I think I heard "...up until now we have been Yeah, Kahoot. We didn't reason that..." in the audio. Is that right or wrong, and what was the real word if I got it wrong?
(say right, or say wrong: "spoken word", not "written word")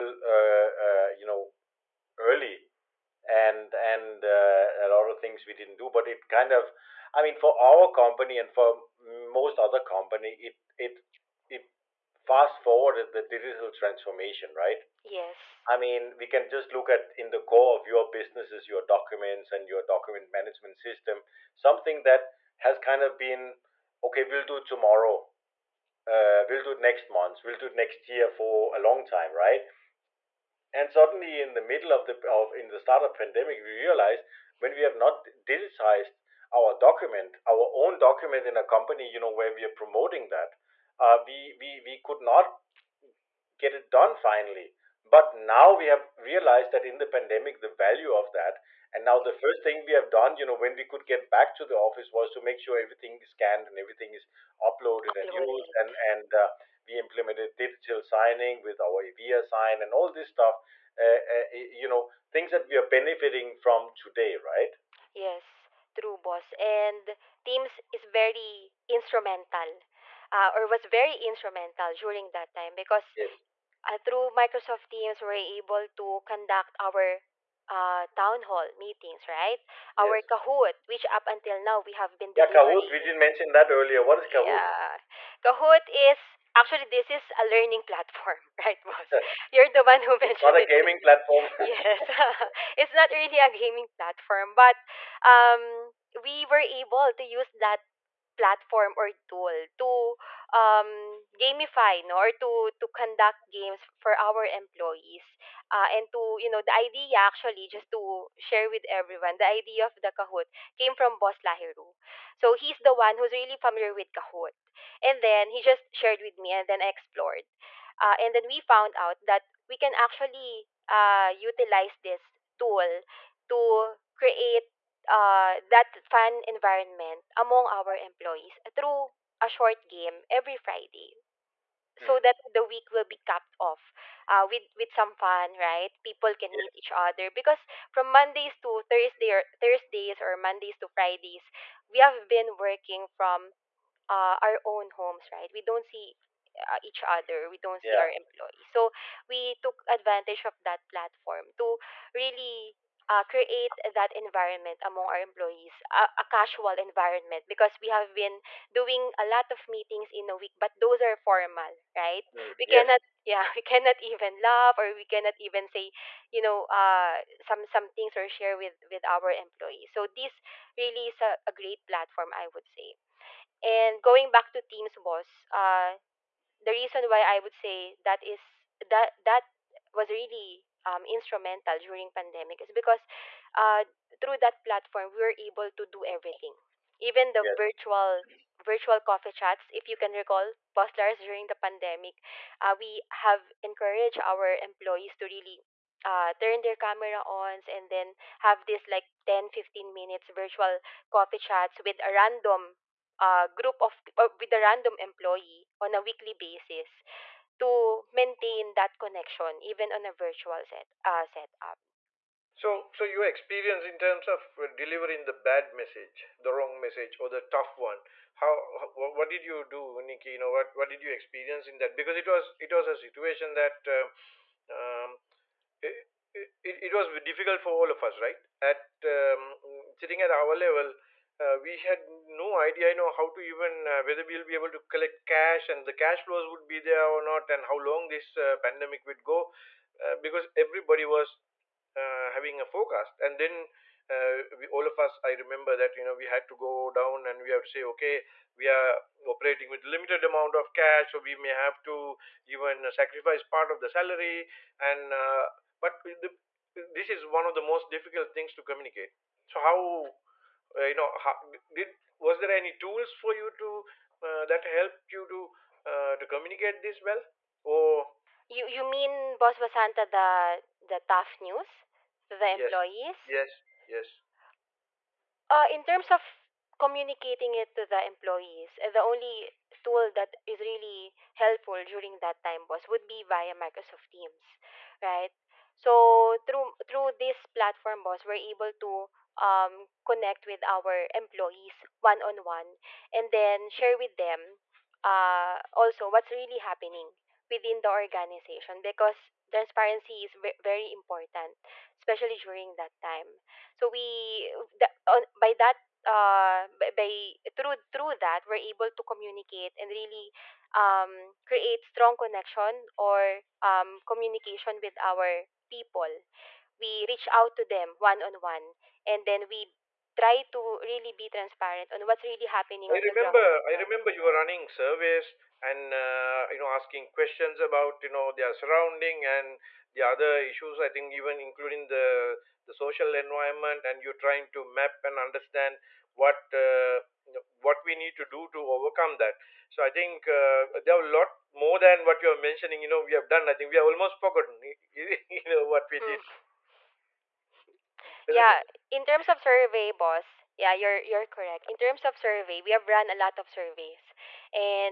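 wrong: "mention", not "reason".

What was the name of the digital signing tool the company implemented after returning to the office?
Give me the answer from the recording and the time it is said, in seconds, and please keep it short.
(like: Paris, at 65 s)
EVA sign, at 59 s.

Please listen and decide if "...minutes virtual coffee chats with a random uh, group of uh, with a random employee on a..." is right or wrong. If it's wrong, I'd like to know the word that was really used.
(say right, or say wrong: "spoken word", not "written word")
right.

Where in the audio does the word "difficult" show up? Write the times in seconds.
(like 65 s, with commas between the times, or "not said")
227 s, 257 s.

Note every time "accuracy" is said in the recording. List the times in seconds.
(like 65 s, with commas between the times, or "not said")
not said.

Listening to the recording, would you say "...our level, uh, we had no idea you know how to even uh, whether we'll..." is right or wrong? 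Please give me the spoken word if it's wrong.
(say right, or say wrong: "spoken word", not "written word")
right.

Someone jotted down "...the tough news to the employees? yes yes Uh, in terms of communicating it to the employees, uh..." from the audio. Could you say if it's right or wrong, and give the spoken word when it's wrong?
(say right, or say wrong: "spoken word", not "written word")
right.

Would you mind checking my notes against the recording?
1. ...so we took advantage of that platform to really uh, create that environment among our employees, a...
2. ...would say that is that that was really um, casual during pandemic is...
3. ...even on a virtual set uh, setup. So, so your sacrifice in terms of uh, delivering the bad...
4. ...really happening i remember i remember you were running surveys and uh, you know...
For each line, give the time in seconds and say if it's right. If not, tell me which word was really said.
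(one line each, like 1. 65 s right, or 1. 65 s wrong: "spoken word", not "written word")
1. 148 s right
2. 177 s wrong: "instrumental", not "casual"
3. 209 s wrong: "experience", not "sacrifice"
4. 322 s right.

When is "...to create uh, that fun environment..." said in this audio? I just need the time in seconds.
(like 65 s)
123 s.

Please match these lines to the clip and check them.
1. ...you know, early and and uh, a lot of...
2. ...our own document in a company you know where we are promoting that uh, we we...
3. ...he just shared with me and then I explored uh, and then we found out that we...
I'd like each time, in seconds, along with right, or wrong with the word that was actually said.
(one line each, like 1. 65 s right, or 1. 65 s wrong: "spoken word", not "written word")
1. 1 s right
2. 37 s right
3. 115 s right.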